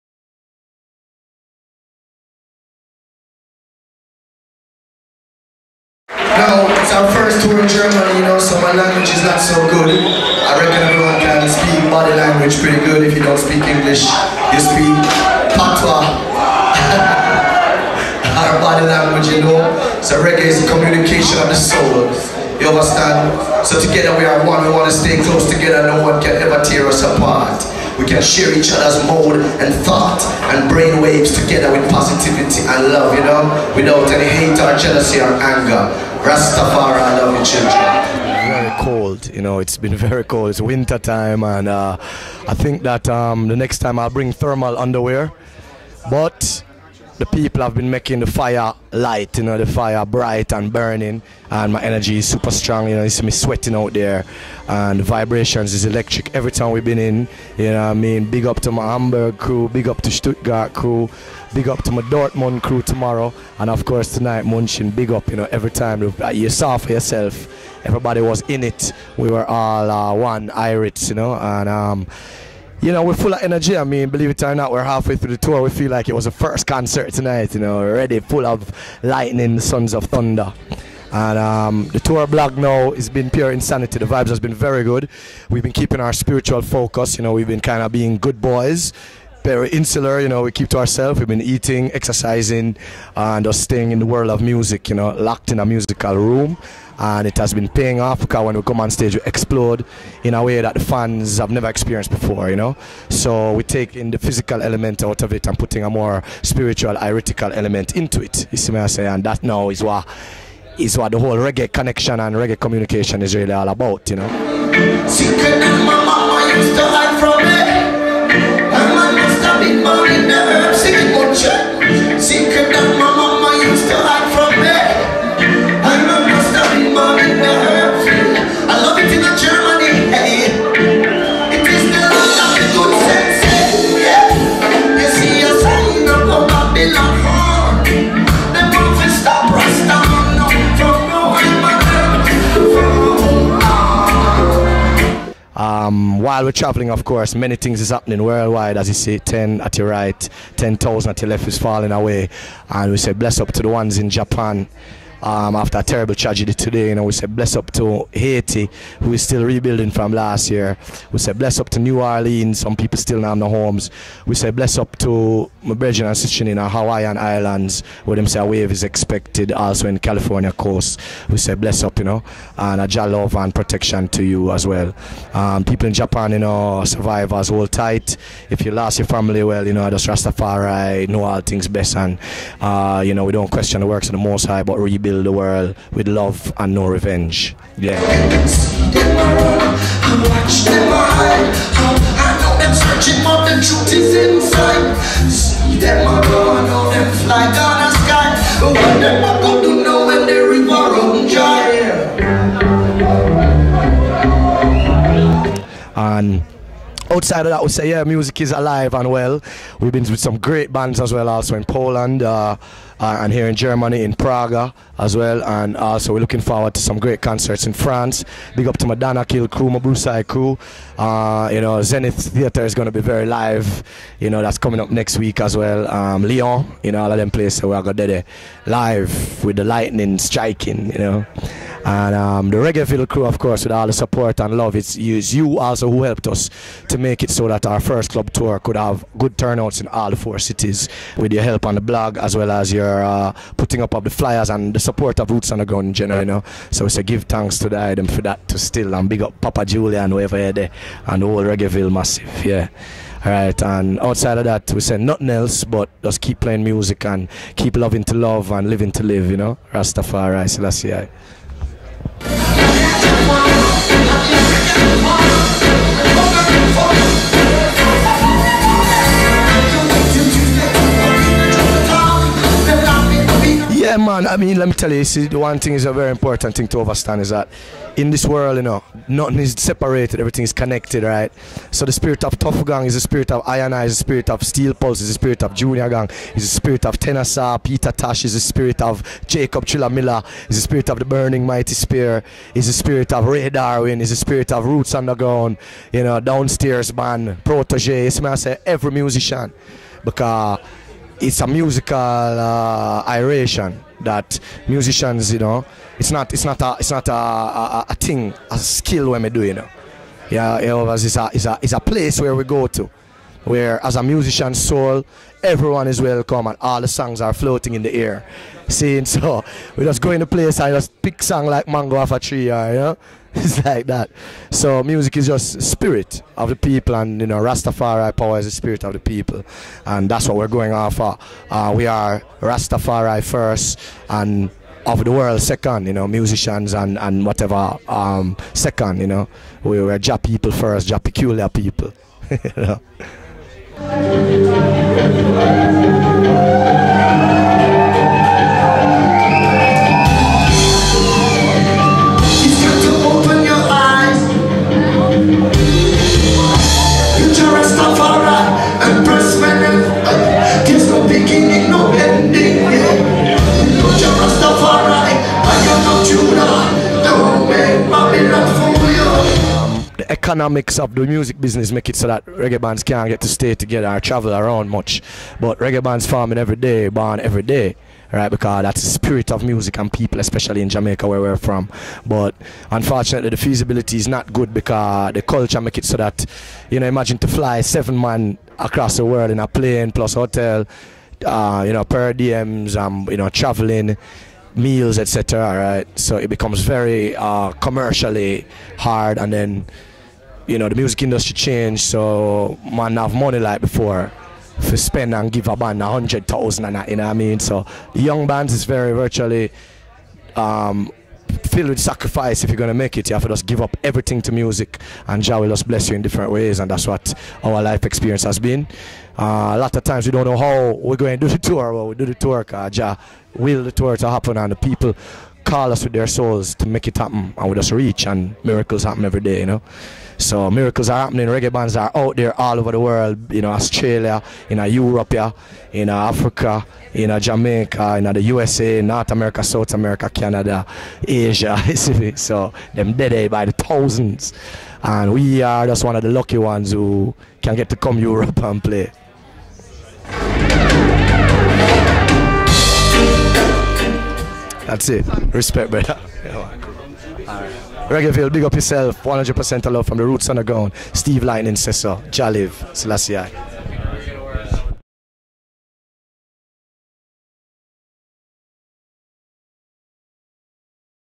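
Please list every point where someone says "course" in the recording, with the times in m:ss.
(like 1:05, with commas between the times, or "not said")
1:03, 2:27, 3:53.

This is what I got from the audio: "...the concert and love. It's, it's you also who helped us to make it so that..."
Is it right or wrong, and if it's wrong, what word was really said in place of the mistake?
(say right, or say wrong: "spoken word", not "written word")
wrong: "support", not "concert".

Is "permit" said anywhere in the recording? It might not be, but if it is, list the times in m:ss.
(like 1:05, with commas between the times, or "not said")
not said.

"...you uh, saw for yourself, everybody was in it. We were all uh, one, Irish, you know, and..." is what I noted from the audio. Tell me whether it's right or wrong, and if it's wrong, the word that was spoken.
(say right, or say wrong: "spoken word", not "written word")
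right.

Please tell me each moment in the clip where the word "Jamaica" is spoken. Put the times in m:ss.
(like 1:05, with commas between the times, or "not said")
6:20, 7:17.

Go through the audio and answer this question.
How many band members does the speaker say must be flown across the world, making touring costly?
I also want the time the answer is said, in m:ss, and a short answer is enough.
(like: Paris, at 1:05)
7, at 6:27.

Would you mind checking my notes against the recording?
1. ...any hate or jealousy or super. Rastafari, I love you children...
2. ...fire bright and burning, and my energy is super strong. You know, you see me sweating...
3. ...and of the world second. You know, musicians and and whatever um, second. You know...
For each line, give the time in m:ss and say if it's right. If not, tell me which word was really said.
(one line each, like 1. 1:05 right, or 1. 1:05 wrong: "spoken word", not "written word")
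1. 0:34 wrong: "anger", not "super"
2. 0:49 right
3. 5:34 right.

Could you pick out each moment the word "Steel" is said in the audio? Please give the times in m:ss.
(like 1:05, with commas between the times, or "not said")
4:44.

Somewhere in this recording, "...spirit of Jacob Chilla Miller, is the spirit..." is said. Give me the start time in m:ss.
4:48.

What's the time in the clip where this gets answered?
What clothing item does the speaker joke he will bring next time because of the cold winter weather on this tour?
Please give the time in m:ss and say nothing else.
0:44.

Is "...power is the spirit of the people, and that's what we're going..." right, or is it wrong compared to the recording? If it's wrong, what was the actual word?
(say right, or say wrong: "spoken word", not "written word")
right.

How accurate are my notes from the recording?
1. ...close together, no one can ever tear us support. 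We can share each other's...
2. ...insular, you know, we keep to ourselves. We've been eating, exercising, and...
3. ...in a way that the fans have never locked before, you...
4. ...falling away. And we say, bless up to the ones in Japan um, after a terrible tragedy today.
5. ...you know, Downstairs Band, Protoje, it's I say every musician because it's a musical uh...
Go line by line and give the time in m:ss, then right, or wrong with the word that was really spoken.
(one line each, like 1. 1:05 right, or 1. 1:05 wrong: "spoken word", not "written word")
1. 0:25 wrong: "apart", not "support"
2. 1:29 right
3. 1:40 wrong: "experienced", not "locked"
4. 2:31 right
5. 4:55 right.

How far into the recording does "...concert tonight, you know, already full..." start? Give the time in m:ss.
1:16.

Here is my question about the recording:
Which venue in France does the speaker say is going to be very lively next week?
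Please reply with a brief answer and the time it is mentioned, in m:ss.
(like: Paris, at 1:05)
Zenith Theatre, at 3:41.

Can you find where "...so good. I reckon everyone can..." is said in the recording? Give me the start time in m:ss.
0:09.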